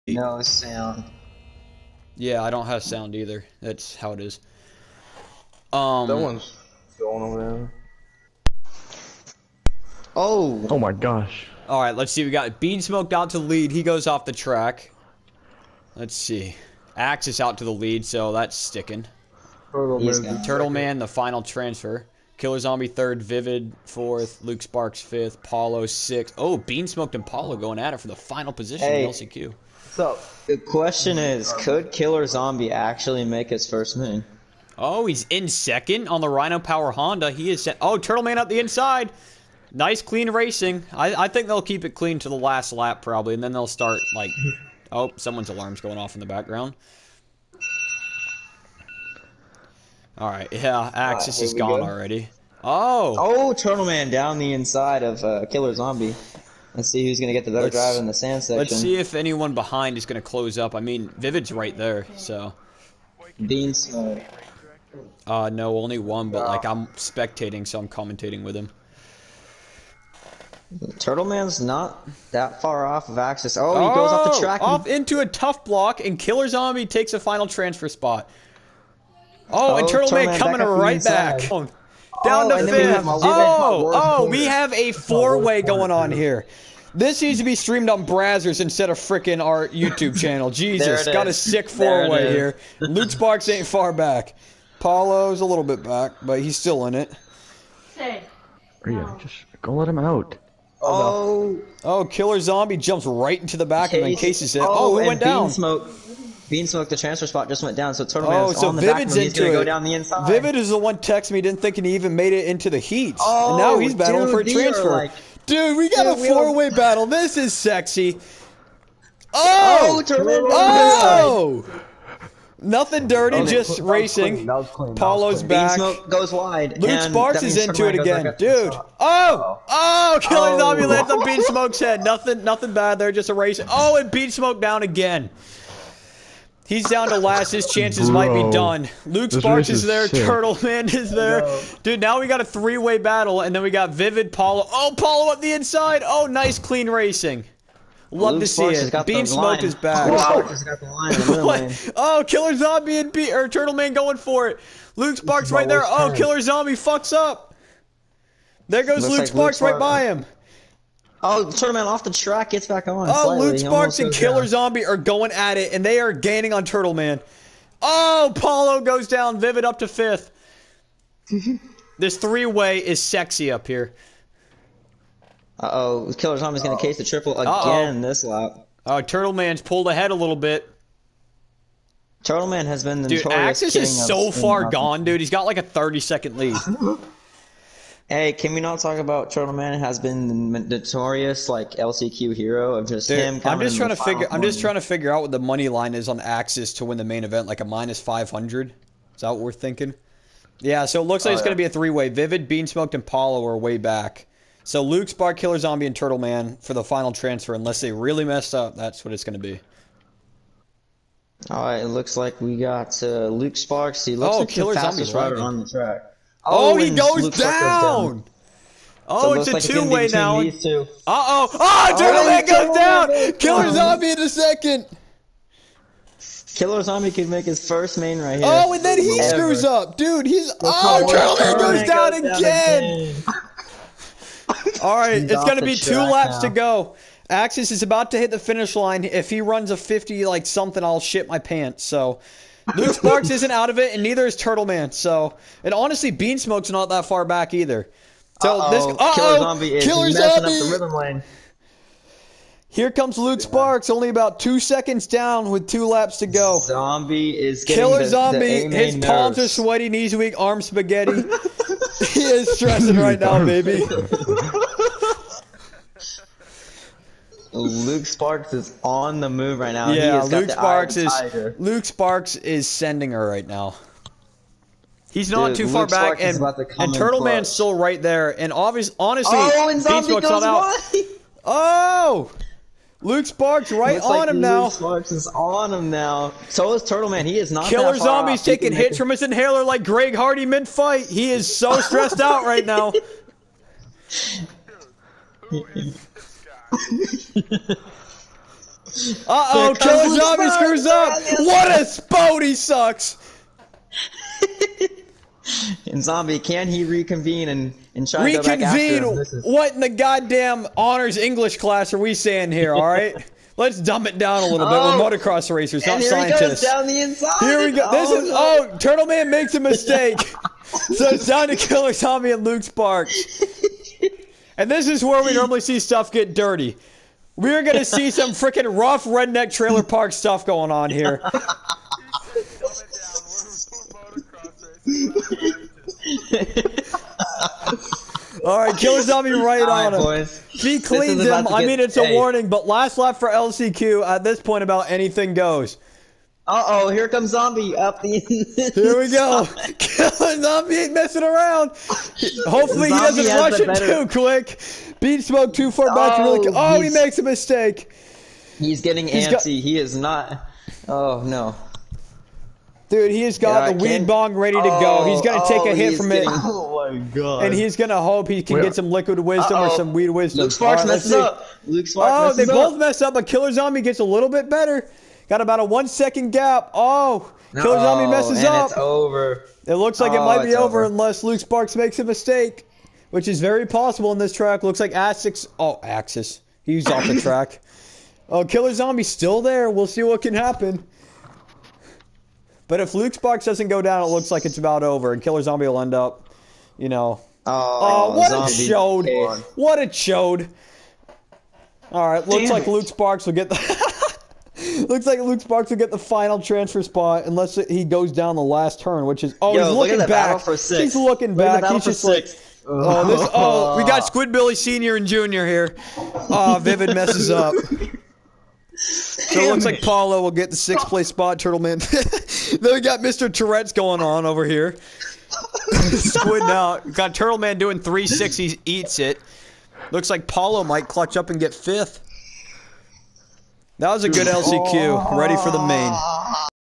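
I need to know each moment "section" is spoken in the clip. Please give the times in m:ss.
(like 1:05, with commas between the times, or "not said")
0:58.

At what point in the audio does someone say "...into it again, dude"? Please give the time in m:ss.
2:07.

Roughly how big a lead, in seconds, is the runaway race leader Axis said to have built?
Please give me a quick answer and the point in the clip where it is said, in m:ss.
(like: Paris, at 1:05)
30 seconds, at 3:05.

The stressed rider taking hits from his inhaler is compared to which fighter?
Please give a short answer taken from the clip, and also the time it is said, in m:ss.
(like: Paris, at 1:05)
Greg Hardy, at 4:49.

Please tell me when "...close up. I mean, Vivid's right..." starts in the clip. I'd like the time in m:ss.
1:00.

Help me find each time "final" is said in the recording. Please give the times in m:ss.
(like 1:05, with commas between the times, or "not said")
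0:21, 0:28, 1:17, 3:26, 6:45.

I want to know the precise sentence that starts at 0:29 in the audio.
So the question is, could Killer Zombie actually make his first moon?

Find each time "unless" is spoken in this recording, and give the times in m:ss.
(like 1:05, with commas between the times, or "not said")
3:27, 6:20, 6:47.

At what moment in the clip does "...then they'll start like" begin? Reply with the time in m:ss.
0:43.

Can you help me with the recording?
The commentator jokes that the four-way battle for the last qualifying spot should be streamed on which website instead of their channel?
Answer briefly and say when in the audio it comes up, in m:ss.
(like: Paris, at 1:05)
Brazzers, at 1:28.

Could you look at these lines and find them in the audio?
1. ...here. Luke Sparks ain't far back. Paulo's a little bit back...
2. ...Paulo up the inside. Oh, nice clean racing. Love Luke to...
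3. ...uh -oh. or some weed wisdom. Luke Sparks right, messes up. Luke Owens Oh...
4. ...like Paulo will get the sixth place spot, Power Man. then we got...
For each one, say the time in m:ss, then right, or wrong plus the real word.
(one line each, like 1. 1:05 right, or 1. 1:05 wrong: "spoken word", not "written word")
1. 1:32 right
2. 2:24 right
3. 6:09 wrong: "Sparks", not "Owens"
4. 6:59 wrong: "Turtle", not "Power".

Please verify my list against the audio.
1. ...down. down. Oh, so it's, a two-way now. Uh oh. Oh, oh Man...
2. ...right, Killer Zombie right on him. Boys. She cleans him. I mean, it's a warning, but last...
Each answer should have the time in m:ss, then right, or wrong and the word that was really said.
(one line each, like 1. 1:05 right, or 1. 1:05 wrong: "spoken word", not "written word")
1. 3:37 right
2. 5:38 right.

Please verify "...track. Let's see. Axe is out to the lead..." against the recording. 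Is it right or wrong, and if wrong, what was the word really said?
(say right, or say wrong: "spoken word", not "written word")
right.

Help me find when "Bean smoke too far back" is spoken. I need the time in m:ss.
5:54.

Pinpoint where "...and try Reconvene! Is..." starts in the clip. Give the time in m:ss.
5:07.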